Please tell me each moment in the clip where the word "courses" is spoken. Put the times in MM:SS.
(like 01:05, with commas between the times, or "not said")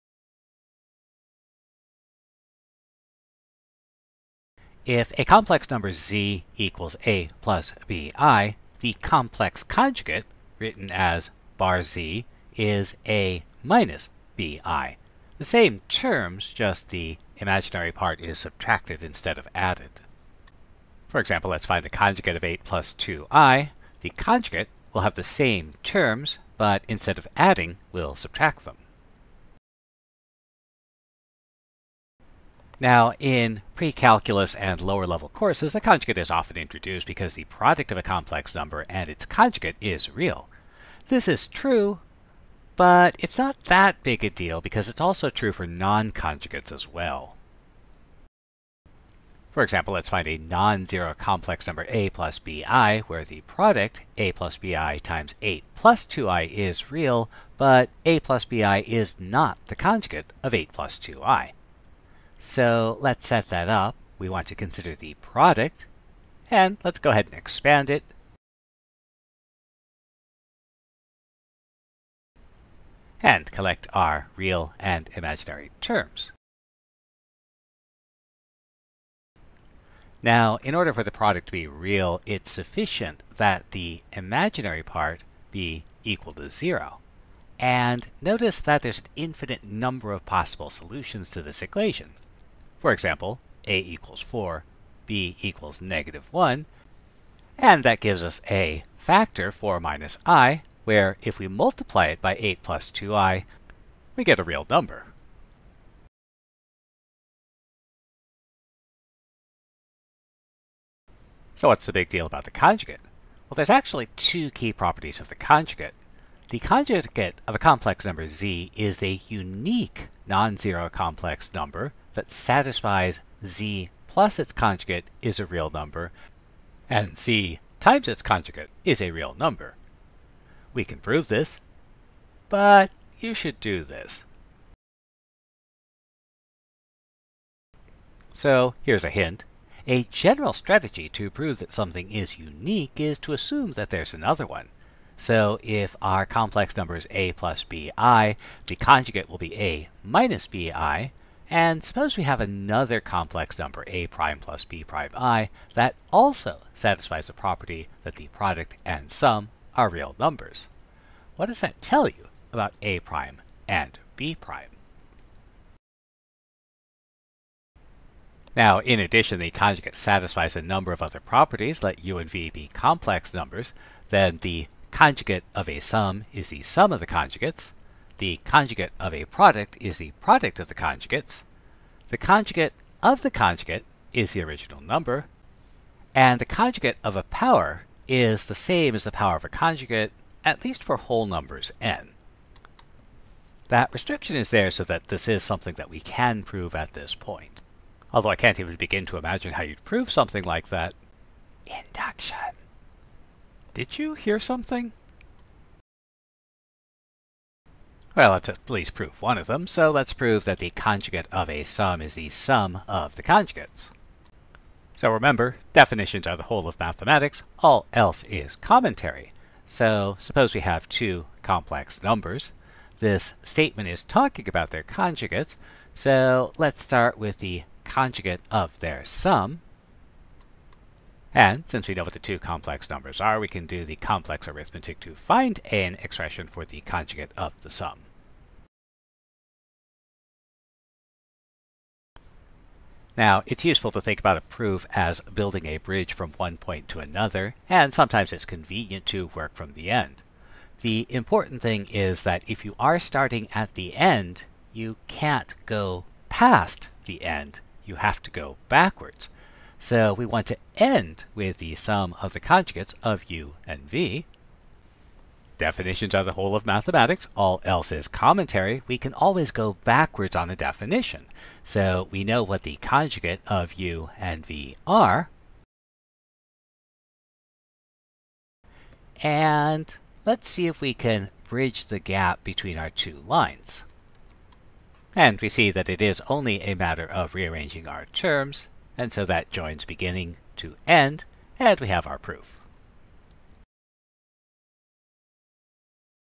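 00:35.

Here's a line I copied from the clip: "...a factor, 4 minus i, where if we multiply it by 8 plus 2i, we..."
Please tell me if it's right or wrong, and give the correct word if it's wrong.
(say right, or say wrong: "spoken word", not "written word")
right.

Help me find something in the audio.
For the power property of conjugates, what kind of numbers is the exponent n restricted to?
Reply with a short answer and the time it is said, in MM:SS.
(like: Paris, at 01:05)
whole numbers, at 03:10.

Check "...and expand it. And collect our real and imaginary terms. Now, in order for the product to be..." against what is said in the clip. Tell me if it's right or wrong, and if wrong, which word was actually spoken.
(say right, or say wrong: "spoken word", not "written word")
right.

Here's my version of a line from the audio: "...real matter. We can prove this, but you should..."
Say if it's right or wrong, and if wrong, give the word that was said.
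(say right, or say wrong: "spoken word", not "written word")
wrong: "number", not "matter".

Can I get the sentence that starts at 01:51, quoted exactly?
So what's the big deal about the conjugate?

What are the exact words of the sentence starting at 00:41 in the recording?
This is true, but it's not that big a deal because it's also true for non-conjugates as well.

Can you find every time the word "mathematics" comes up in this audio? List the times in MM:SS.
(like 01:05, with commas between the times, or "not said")
03:36, 04:26.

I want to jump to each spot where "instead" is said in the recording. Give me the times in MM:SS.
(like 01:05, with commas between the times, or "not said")
00:19, 00:26.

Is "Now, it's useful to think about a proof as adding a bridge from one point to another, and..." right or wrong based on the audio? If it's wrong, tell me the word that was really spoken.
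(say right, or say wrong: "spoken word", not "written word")
wrong: "building", not "adding".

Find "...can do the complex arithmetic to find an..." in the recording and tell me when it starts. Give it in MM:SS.
03:53.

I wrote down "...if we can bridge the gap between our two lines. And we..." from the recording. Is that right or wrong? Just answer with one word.
right.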